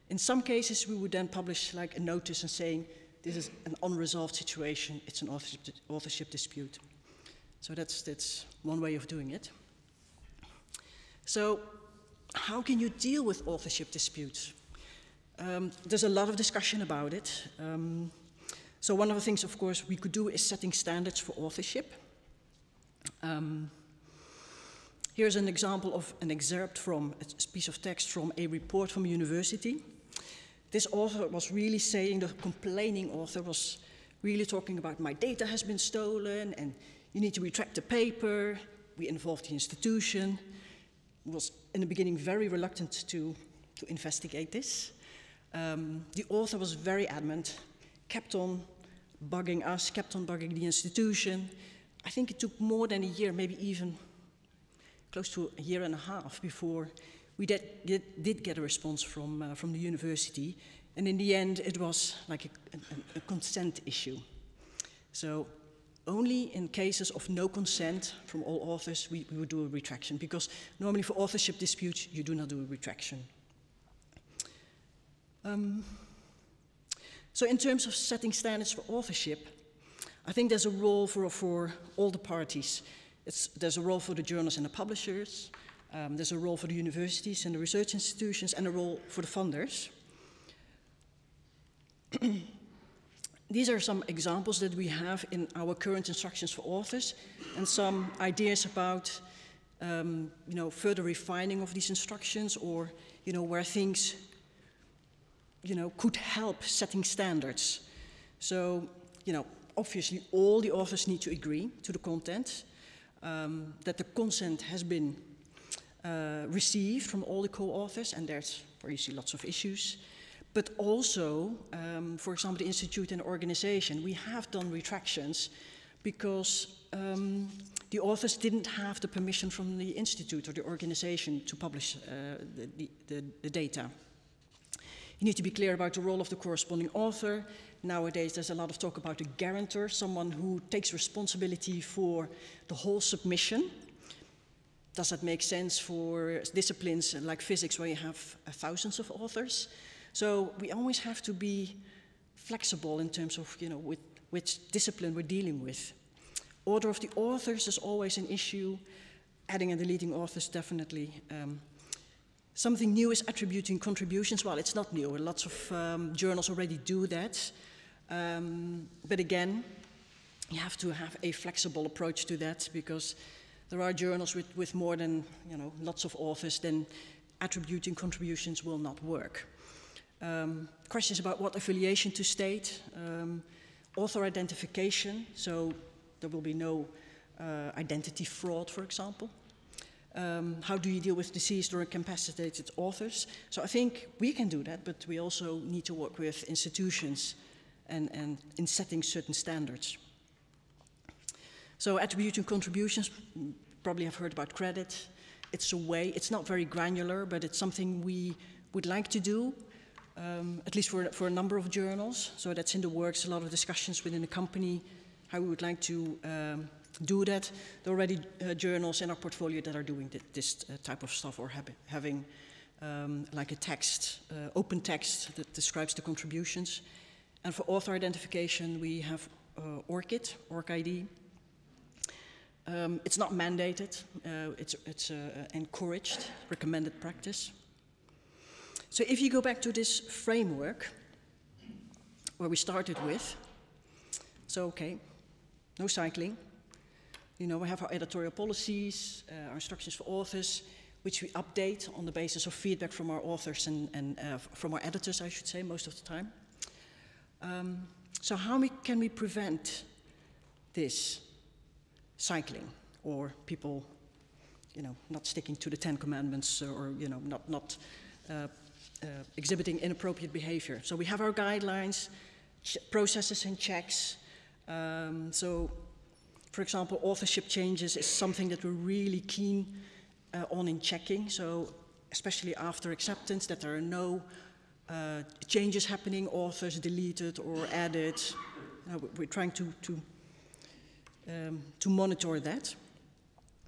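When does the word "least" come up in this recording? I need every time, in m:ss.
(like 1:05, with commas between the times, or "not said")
3:30.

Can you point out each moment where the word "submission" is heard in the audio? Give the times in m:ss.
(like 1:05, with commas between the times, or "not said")
2:23.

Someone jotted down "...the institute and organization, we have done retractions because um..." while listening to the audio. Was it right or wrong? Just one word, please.
right.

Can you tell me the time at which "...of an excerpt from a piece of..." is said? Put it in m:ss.
0:25.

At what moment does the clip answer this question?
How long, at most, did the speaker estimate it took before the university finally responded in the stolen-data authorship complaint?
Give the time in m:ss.
0:55.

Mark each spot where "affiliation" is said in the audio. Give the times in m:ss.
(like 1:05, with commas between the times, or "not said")
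3:01.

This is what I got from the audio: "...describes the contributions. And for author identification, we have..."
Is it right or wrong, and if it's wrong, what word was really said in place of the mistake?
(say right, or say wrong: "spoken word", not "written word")
right.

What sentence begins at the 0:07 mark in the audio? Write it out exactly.
So that's, that's one way of doing it.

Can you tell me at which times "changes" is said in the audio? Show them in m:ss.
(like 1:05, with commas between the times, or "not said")
4:37, 4:45.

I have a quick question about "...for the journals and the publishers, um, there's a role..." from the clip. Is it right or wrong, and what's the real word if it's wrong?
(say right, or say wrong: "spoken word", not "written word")
right.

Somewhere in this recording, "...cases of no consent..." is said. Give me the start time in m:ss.
1:06.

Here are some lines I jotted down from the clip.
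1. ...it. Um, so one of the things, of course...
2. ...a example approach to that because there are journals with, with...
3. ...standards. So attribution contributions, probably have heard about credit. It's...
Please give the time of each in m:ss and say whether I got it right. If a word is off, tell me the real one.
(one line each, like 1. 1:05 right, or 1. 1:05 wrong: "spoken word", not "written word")
1. 0:17 right
2. 2:51 wrong: "flexible", not "example"
3. 3:19 right.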